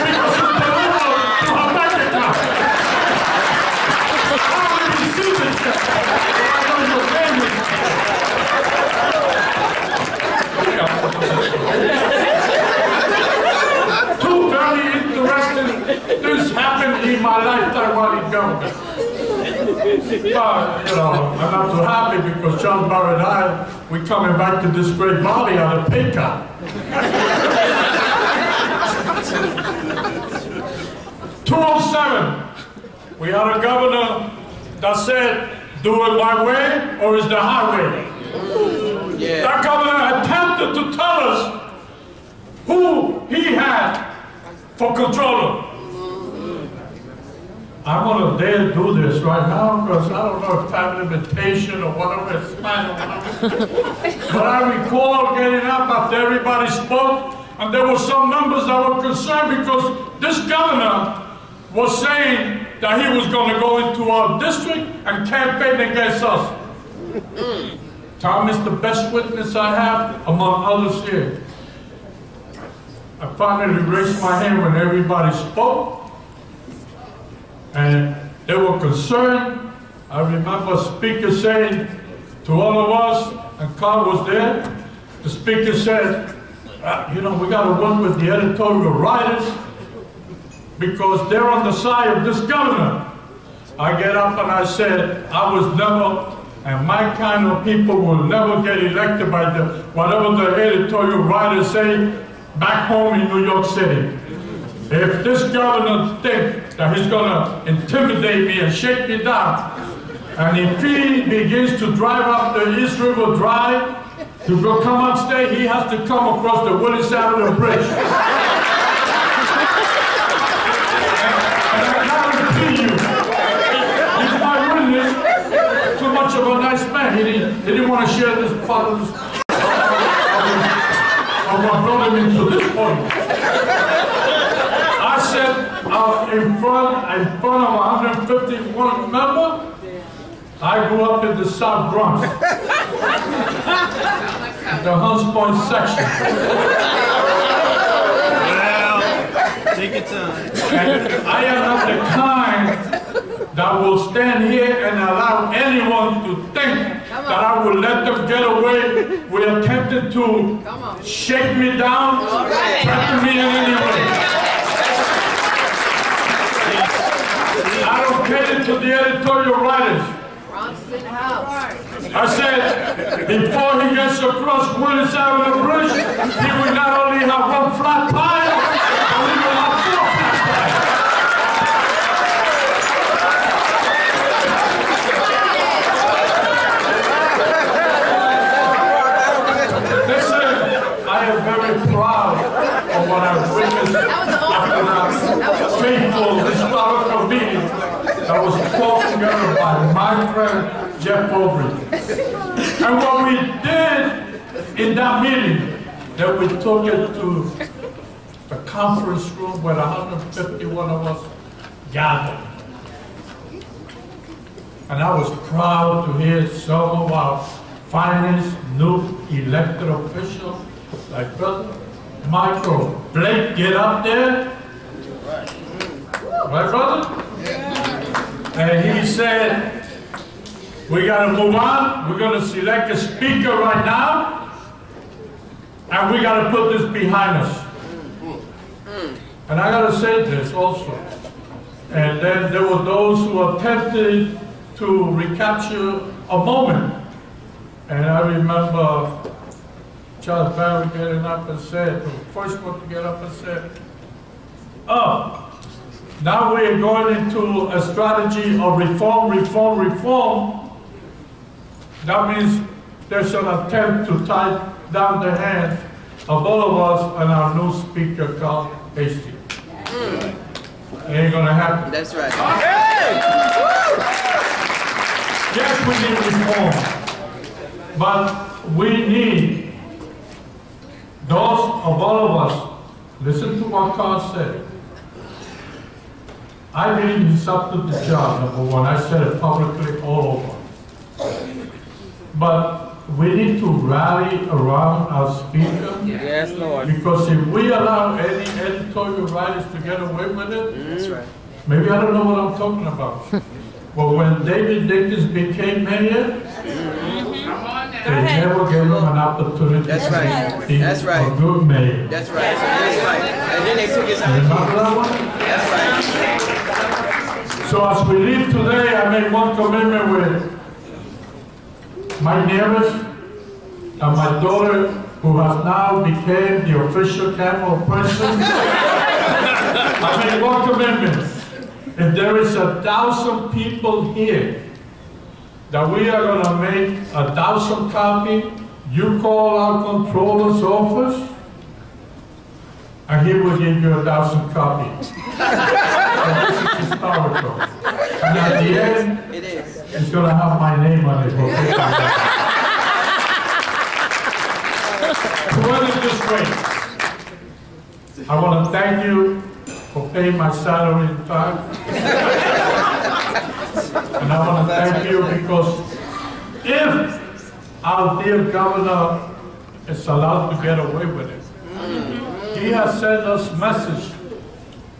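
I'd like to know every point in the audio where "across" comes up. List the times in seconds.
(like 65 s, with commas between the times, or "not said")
116 s, 174 s.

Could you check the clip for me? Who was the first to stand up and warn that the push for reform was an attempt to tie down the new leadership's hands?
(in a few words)
Charles Barron.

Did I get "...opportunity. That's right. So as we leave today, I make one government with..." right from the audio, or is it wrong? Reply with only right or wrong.
wrong.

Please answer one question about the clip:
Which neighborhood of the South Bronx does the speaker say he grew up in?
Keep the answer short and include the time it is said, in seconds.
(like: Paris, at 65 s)
Hunts Point, at 145 s.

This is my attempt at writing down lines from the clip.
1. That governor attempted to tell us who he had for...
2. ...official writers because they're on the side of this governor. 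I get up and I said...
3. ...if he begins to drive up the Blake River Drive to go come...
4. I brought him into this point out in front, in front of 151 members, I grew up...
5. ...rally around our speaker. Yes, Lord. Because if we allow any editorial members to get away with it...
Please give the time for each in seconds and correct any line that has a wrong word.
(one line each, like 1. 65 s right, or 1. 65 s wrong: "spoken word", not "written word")
1. 39 s right
2. 88 s wrong: "editorial", not "official"
3. 110 s wrong: "East", not "Blake"
4. 129 s right
5. 293 s wrong: "writers", not "members".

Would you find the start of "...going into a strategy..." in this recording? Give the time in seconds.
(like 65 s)
256 s.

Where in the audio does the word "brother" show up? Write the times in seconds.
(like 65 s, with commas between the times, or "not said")
221 s, 226 s.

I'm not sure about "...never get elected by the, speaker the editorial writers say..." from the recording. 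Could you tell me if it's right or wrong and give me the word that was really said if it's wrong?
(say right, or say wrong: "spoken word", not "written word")
wrong: "whatever", not "speaker".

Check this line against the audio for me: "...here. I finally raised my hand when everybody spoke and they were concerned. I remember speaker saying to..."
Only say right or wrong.
right.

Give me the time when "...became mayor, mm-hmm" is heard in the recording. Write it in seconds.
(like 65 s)
305 s.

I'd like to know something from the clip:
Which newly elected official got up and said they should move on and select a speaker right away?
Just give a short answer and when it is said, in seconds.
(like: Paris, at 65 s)
Michael Blake, at 222 s.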